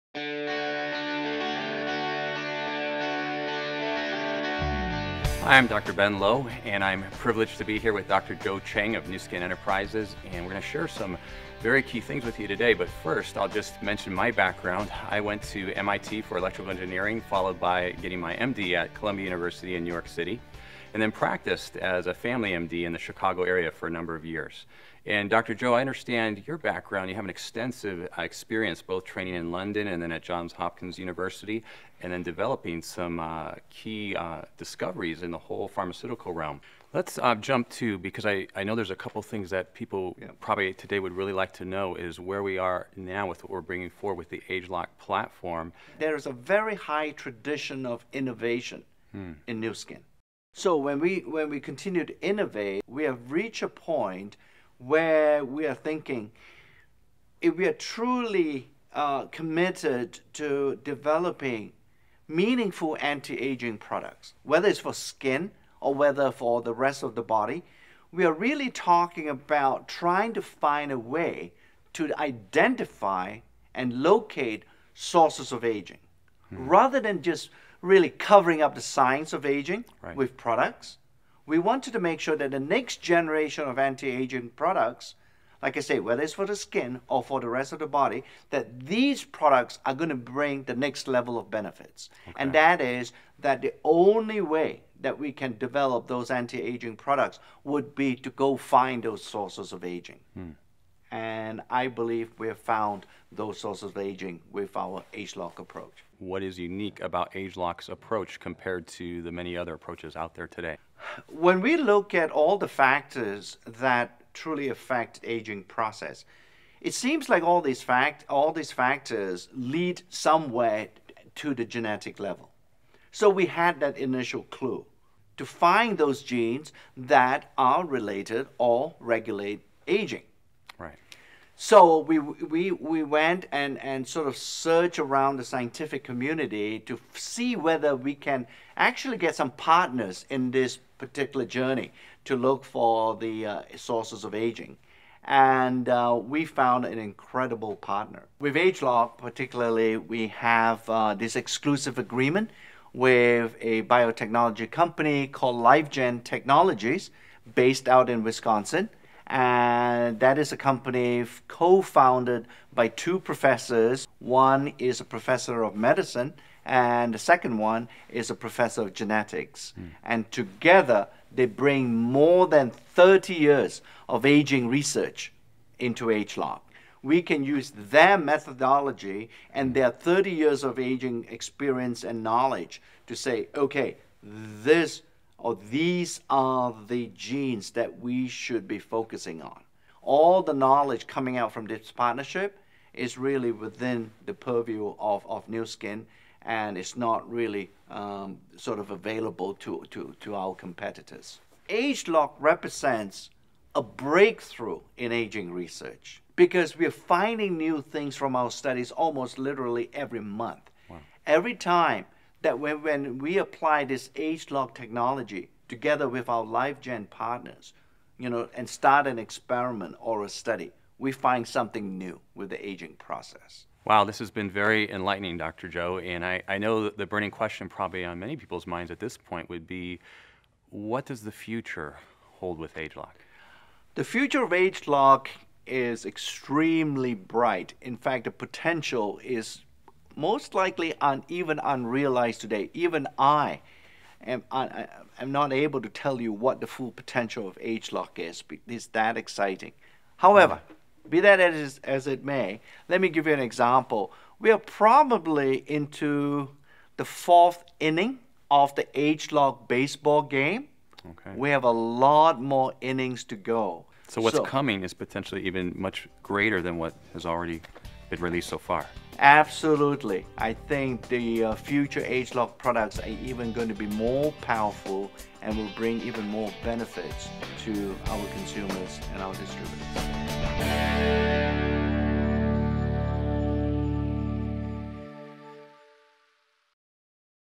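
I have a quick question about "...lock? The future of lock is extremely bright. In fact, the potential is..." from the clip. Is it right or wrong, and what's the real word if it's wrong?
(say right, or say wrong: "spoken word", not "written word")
right.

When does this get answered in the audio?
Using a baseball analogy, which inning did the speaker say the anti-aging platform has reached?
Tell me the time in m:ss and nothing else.
4:17.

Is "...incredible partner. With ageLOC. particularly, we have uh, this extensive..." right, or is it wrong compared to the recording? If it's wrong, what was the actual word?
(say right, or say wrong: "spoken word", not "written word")
wrong: "exclusive", not "extensive".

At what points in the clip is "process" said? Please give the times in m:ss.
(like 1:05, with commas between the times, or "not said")
1:55, 3:42.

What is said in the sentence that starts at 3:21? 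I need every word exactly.
ageLOC represents a breakthrough in aging research because we're finding new things from our studies almost literally every month.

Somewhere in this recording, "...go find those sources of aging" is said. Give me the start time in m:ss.
1:38.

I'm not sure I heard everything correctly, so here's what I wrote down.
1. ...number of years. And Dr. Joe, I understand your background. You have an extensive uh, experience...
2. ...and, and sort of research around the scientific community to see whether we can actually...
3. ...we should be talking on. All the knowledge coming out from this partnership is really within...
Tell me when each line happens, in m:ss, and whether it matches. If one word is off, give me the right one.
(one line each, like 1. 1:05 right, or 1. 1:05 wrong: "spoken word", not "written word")
1. 0:23 right
2. 2:13 wrong: "search", not "research"
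3. 3:07 wrong: "focusing", not "talking".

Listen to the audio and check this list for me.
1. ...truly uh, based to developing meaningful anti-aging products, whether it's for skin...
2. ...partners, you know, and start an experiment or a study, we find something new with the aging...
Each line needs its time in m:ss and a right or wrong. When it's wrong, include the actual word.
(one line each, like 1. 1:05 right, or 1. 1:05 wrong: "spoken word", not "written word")
1. 0:57 wrong: "committed", not "based"
2. 3:37 right.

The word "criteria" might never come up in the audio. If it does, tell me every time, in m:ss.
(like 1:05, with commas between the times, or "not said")
not said.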